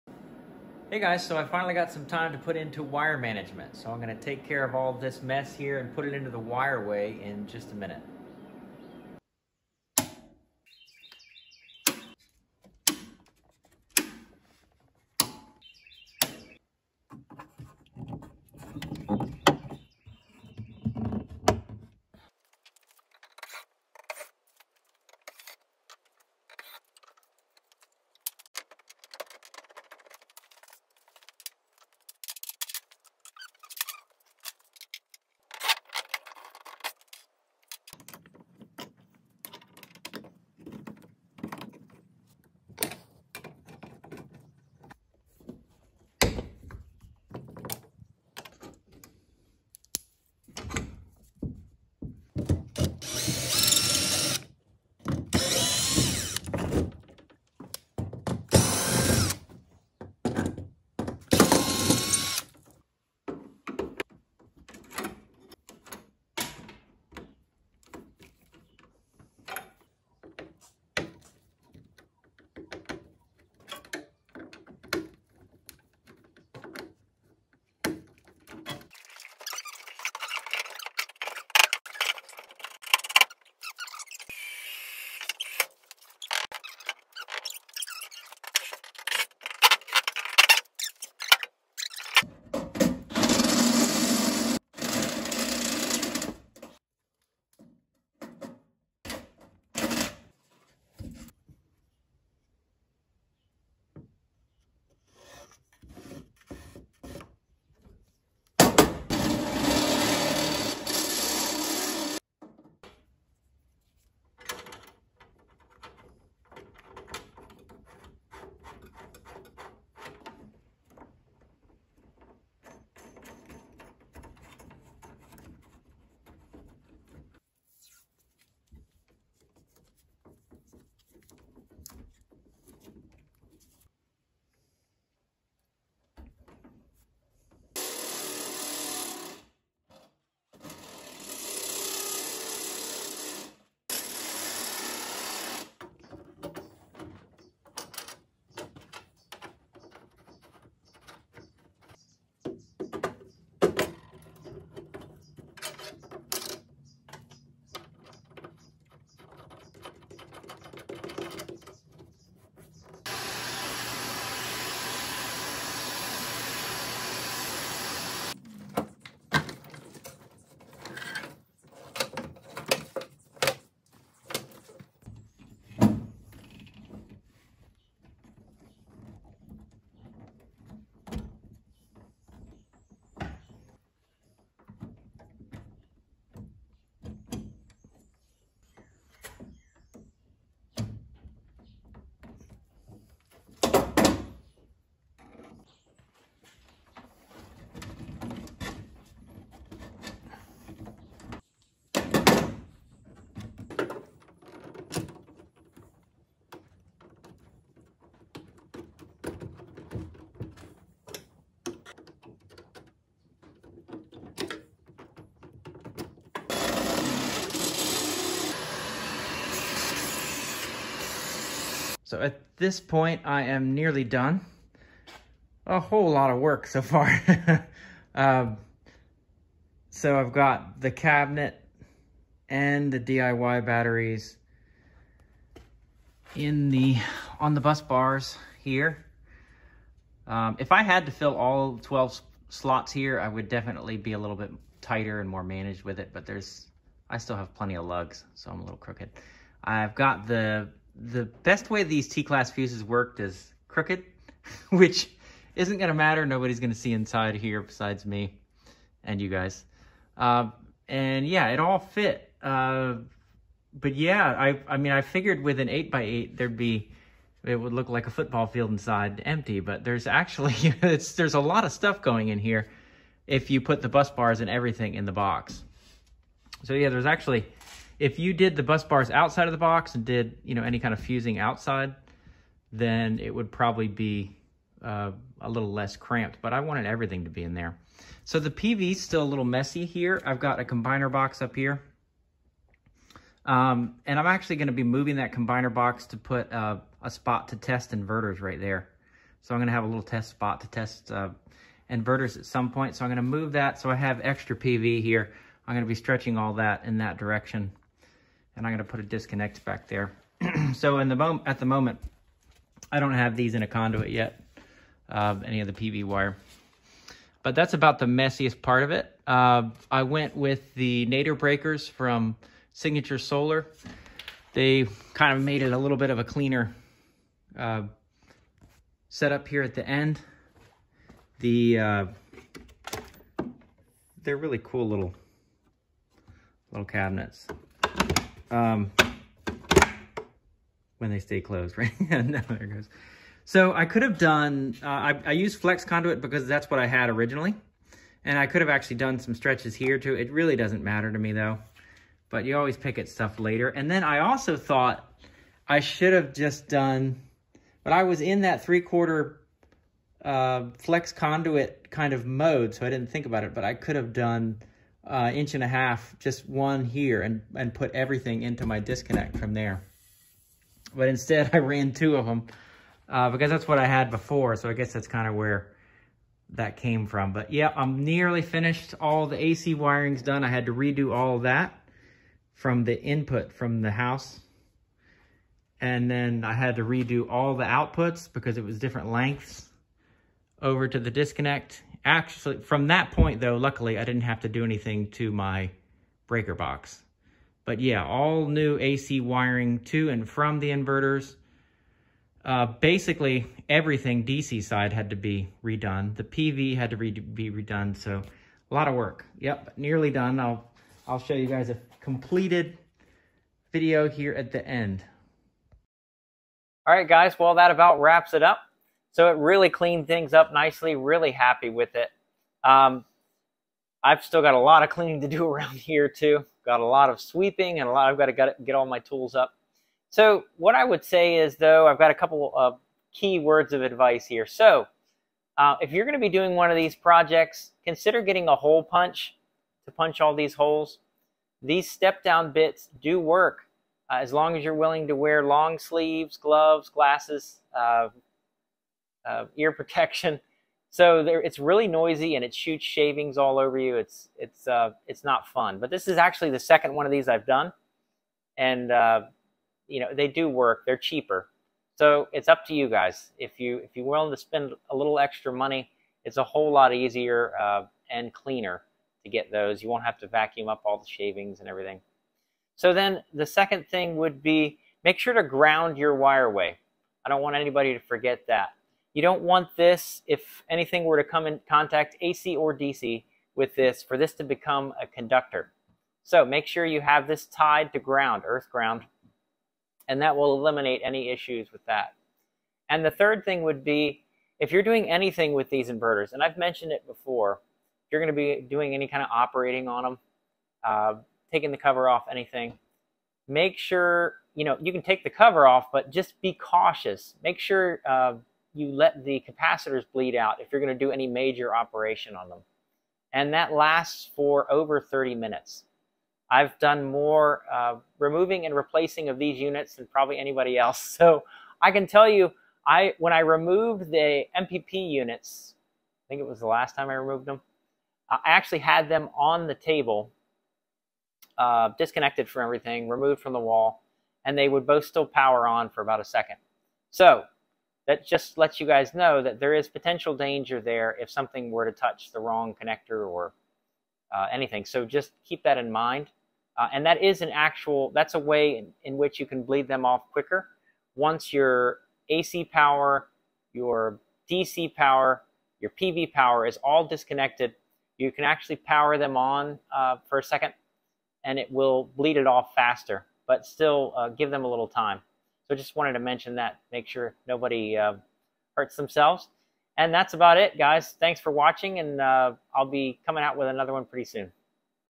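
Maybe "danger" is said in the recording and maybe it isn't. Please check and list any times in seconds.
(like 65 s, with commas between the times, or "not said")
540 s.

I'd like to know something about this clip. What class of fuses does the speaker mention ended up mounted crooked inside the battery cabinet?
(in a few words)
T-class.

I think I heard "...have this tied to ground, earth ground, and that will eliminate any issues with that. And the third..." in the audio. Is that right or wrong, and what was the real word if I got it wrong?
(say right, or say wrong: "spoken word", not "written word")
right.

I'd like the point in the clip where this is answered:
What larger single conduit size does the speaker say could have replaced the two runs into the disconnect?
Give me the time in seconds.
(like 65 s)
365 s.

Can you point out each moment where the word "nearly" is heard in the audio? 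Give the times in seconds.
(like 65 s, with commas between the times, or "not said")
223 s, 378 s, 409 s.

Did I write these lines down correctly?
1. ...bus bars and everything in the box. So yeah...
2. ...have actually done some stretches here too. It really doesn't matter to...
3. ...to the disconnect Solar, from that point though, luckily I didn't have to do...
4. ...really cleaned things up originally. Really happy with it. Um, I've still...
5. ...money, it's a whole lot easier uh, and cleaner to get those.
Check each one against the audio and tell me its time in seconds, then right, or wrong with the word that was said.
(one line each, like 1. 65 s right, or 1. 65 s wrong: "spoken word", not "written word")
1. 273 s right
2. 348 s right
3. 390 s wrong: "Actually", not "Solar"
4. 419 s wrong: "nicely", not "originally"
5. 465 s right.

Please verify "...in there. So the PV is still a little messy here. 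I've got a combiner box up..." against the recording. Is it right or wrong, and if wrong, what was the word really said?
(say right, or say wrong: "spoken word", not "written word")
right.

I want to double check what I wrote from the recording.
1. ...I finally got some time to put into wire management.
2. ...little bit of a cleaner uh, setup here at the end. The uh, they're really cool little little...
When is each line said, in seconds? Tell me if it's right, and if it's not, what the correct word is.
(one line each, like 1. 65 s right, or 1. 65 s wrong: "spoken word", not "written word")
1. 1 s right
2. 325 s right.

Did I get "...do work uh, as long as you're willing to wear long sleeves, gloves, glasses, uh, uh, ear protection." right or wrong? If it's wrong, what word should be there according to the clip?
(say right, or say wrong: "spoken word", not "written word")
right.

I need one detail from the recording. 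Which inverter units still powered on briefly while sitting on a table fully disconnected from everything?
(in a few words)
MPP units.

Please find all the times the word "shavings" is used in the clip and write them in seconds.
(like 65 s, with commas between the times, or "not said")
452 s, 471 s.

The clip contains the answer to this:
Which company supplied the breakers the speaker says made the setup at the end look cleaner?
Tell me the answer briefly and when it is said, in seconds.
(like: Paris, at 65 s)
Signature Solar, at 322 s.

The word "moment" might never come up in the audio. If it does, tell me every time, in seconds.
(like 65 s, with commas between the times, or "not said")
311 s.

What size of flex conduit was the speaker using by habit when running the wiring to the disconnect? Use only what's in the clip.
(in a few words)
three quarter.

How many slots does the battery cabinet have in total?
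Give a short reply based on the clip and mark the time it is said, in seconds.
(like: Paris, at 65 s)
12, at 241 s.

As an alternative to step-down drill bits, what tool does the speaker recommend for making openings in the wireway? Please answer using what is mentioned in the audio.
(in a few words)
hole punch.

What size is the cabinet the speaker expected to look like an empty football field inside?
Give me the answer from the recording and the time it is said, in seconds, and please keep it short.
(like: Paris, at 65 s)
8x8, at 265 s.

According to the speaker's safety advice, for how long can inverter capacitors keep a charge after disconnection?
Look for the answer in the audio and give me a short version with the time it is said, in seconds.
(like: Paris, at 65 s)
over 30 minutes, at 514 s.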